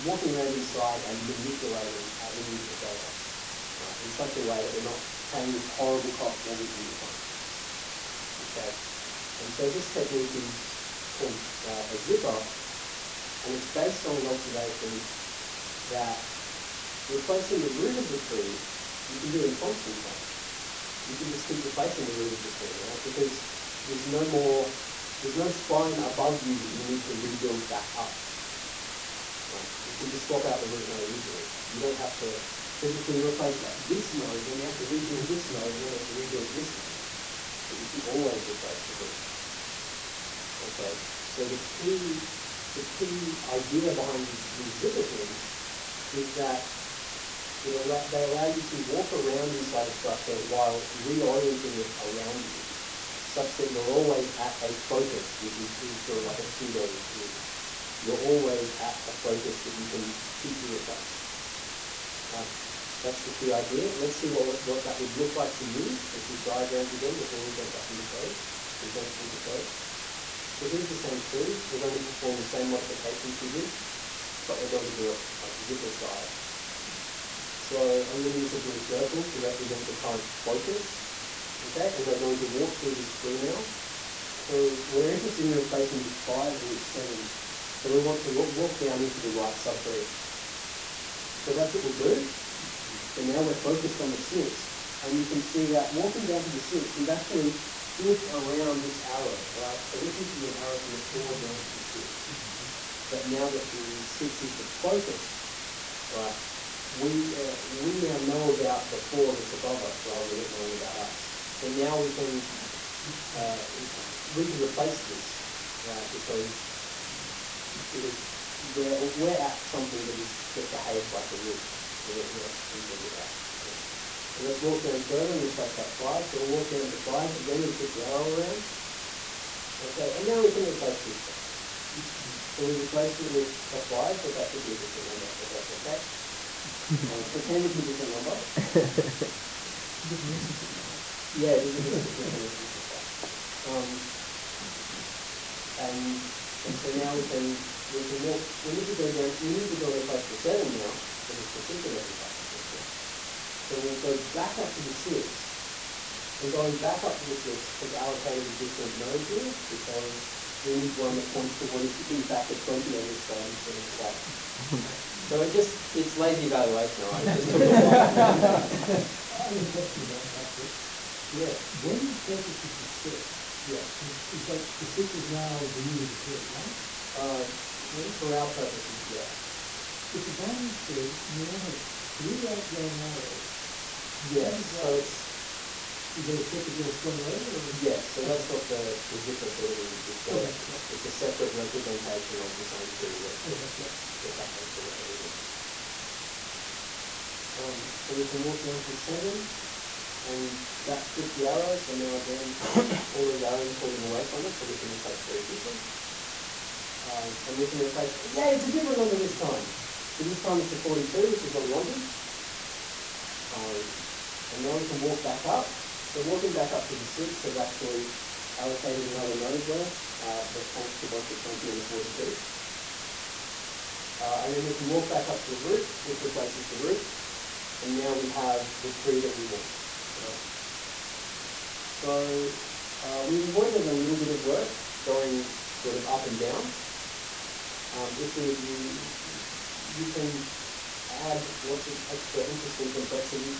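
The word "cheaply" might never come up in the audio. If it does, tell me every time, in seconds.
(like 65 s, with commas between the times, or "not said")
60 s, 205 s.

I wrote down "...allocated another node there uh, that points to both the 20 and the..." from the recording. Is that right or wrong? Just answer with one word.
right.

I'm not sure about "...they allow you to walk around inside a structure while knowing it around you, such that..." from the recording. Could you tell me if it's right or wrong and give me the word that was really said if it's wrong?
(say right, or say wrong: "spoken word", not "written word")
wrong: "reorienting", not "knowing".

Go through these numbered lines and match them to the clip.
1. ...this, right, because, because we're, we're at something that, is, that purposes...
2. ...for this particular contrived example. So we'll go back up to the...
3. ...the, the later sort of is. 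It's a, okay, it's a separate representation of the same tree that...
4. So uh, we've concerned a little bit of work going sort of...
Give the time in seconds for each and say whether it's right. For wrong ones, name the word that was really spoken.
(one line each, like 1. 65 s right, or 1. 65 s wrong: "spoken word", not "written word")
1. 115 s wrong: "behaves", not "purposes"
2. 151 s right
3. 188 s wrong: "zipper", not "later"
4. 231 s wrong: "avoided", not "concerned".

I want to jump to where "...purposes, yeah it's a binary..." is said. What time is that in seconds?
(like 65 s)
178 s.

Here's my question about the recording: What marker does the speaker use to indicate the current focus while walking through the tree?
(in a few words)
blue circle.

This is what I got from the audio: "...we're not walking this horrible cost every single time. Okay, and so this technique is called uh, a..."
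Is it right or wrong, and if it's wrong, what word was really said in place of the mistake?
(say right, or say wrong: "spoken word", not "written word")
wrong: "paying", not "walking".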